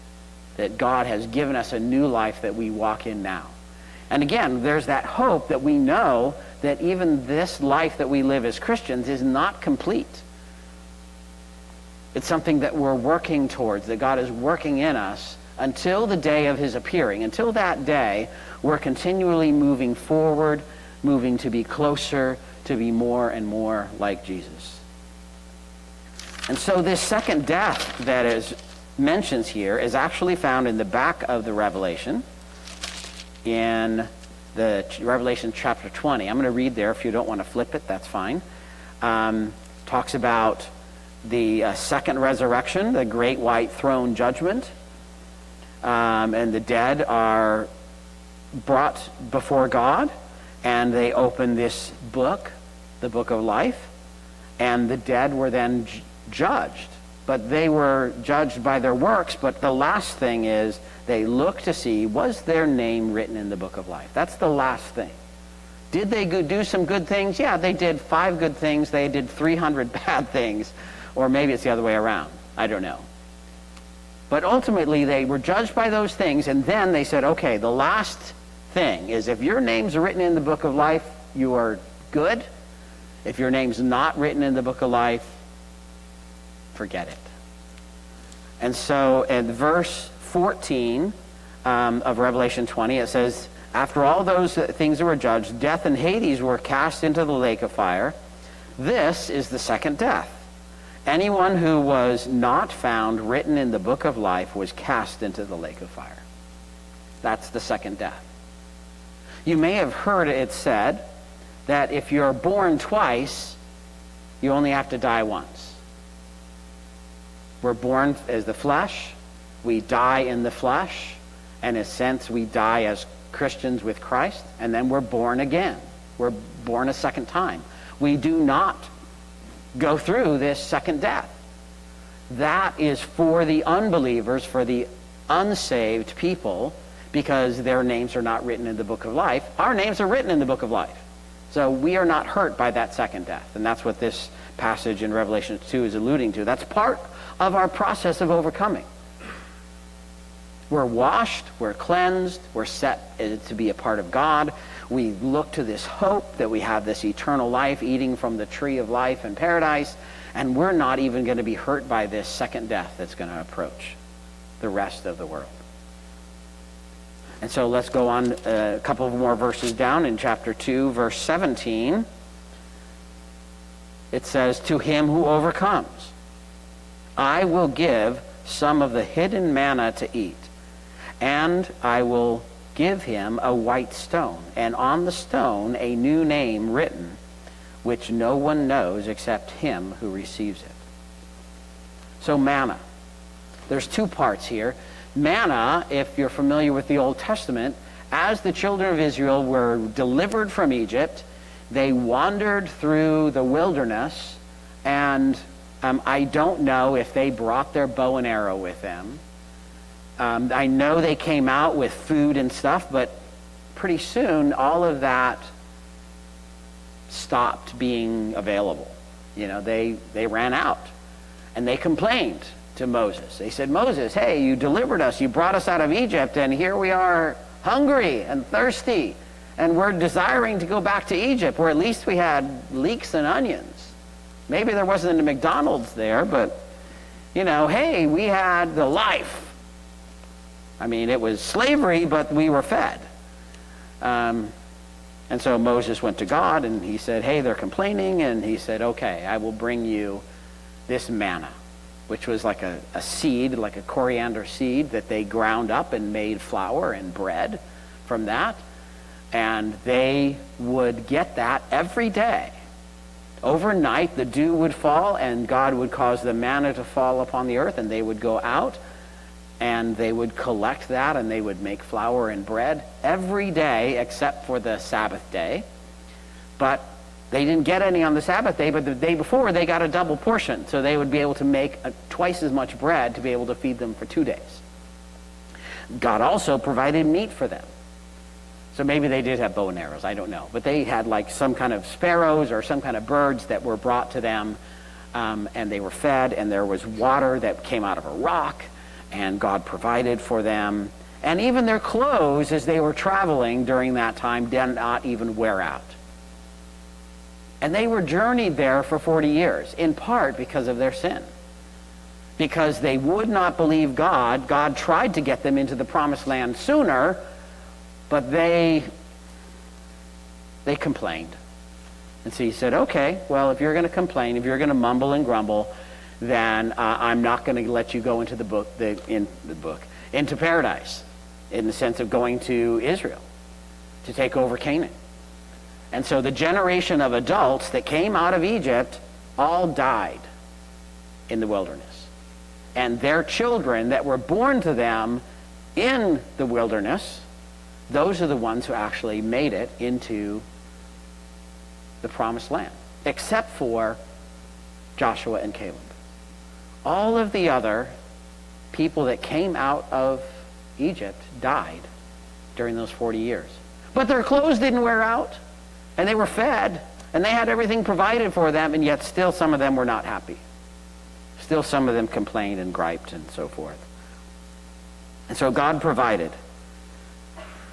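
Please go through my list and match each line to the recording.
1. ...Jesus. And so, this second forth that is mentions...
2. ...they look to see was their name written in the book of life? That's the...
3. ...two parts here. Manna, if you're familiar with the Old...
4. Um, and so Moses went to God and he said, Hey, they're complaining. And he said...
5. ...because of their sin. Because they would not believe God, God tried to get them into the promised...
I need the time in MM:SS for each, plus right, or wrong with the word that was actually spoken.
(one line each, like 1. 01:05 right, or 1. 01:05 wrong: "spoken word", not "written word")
1. 00:24 wrong: "death", not "forth"
2. 01:01 right
3. 03:13 right
4. 04:04 right
5. 05:10 right.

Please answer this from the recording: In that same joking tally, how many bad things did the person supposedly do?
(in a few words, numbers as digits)
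300.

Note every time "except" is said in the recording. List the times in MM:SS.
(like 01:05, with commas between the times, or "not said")
03:09, 04:33, 05:53.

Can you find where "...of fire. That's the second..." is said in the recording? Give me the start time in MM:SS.
01:45.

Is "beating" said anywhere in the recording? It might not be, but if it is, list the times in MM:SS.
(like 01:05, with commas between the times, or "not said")
not said.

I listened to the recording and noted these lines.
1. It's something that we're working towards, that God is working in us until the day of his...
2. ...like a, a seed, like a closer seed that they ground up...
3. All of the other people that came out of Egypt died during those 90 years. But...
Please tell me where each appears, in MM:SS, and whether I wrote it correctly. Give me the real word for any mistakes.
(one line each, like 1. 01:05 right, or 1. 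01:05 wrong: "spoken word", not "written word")
1. 00:12 right
2. 04:12 wrong: "coriander", not "closer"
3. 05:56 wrong: "40", not "90".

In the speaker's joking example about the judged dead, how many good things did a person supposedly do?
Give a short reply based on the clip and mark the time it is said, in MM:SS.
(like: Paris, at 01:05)
5, at 01:07.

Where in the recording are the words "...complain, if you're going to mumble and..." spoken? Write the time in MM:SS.
05:23.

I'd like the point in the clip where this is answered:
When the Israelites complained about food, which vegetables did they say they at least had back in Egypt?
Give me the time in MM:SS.
03:52.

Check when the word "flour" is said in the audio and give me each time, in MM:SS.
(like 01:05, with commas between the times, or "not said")
04:16, 04:31.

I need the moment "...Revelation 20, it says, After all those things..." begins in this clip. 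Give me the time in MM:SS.
01:32.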